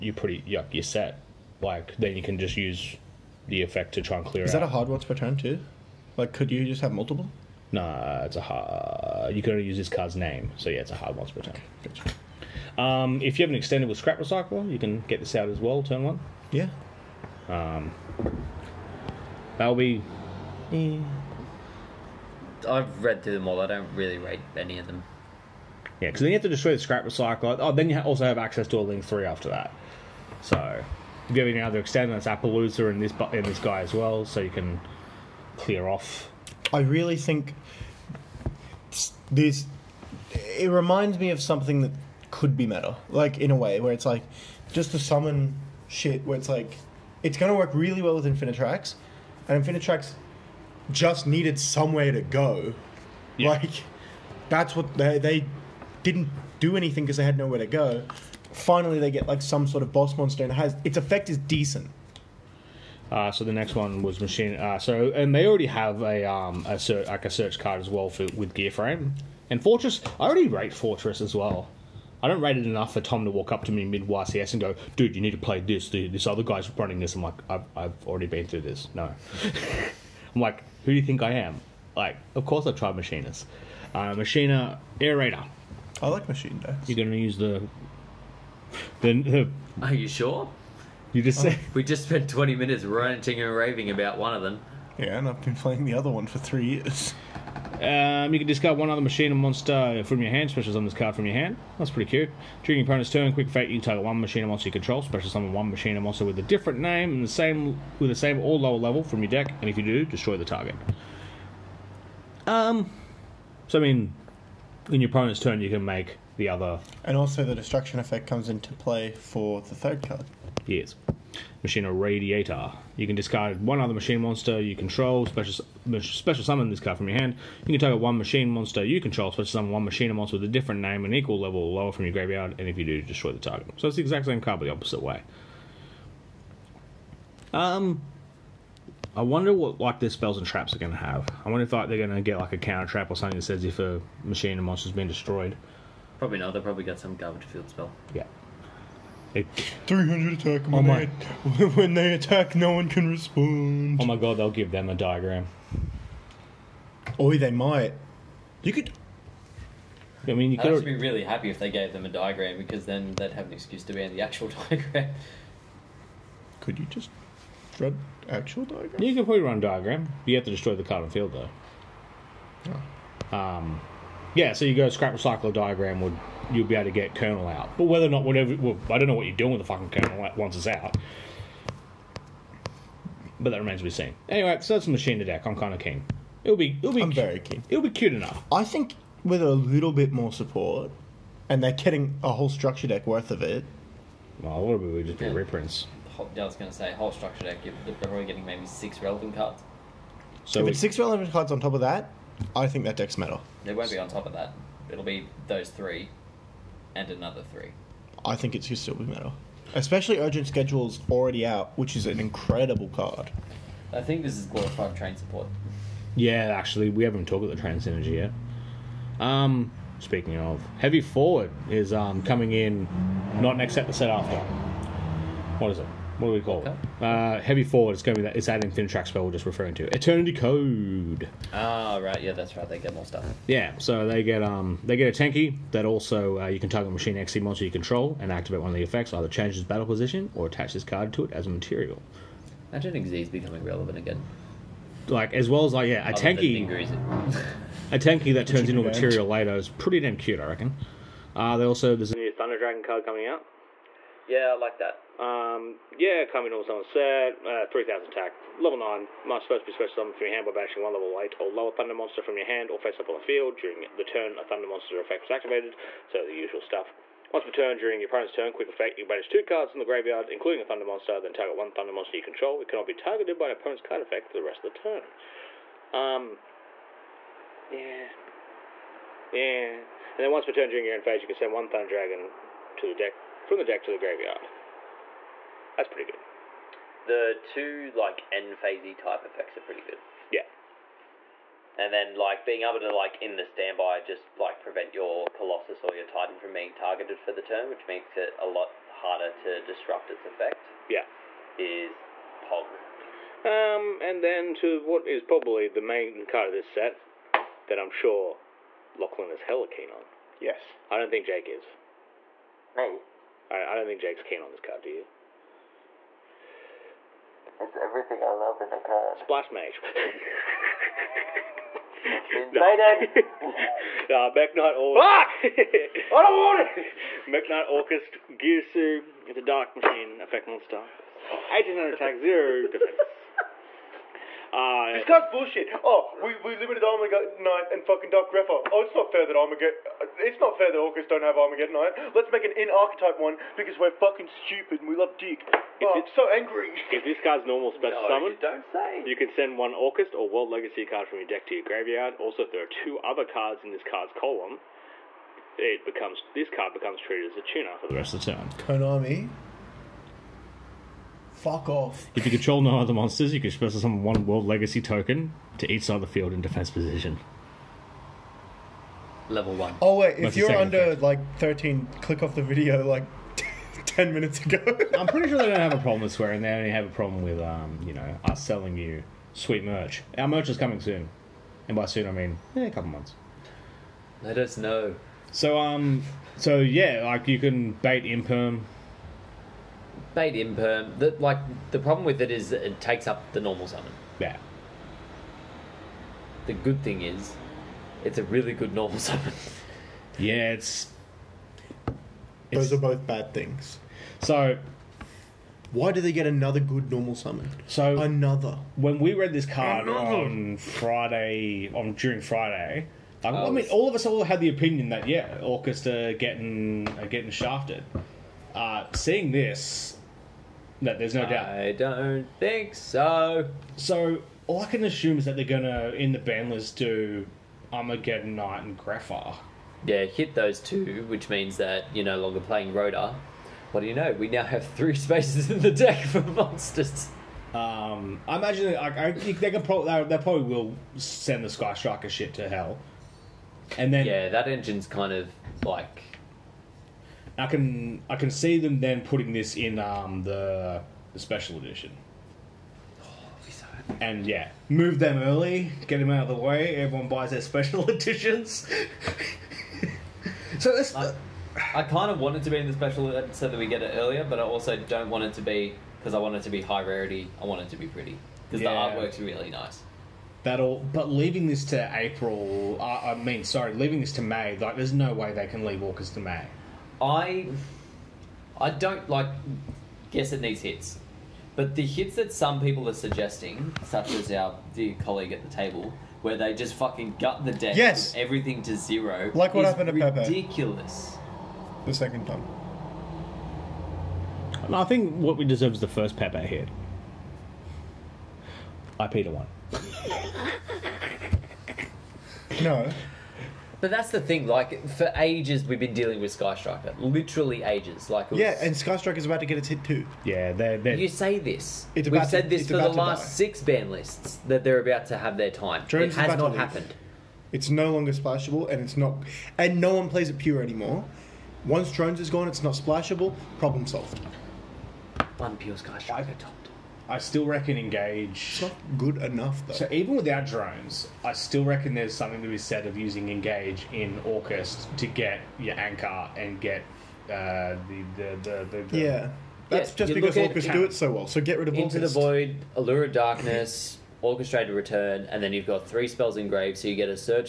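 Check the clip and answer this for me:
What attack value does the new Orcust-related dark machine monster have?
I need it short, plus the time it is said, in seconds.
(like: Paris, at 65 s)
1800, at 330 s.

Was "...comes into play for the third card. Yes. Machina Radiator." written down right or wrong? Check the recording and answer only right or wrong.
right.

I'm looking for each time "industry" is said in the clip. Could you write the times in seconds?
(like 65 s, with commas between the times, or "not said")
not said.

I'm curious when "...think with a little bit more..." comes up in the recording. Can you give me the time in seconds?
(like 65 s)
188 s.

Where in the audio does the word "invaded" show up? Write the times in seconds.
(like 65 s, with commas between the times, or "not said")
322 s.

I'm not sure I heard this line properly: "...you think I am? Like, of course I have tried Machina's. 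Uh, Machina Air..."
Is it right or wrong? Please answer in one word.
right.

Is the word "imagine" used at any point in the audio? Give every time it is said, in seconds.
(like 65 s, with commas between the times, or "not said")
242 s, 438 s.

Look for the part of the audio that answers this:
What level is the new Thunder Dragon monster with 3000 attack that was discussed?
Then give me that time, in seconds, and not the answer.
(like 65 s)
258 s.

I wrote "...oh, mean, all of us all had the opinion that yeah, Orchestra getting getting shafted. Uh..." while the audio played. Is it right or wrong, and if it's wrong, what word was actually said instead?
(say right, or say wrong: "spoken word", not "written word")
right.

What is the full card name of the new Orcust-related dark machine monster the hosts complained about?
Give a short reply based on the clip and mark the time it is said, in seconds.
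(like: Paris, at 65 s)
Mekk-Knight Orcust Girsu, at 327 s.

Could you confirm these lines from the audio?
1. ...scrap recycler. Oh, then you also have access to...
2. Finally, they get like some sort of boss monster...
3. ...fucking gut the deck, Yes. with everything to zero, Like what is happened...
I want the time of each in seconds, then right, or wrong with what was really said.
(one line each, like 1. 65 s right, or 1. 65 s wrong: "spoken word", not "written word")
1. 26 s right
2. 58 s right
3. 486 s right.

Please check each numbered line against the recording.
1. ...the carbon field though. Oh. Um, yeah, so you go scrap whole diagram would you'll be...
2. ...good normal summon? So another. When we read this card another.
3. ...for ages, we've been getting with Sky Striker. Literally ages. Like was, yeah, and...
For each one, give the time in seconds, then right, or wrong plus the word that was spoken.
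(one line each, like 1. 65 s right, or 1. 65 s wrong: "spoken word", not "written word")
1. 170 s wrong: "recycle", not "whole"
2. 406 s right
3. 504 s wrong: "dealing", not "getting".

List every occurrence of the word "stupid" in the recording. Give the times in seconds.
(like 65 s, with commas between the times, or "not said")
344 s.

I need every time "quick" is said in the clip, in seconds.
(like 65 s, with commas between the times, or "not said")
103 s, 268 s.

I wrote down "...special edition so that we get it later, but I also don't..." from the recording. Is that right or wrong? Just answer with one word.
wrong.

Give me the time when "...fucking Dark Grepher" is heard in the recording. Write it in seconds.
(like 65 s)
337 s.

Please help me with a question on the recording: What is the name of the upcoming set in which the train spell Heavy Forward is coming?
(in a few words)
Eternity Code.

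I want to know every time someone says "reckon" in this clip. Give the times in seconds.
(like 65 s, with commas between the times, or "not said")
250 s, 527 s, 531 s.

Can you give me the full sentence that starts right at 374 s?
I'm pretty sure they don't have a problem with swearing.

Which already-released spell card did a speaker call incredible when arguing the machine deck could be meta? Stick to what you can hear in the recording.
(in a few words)
Urgent Schedule.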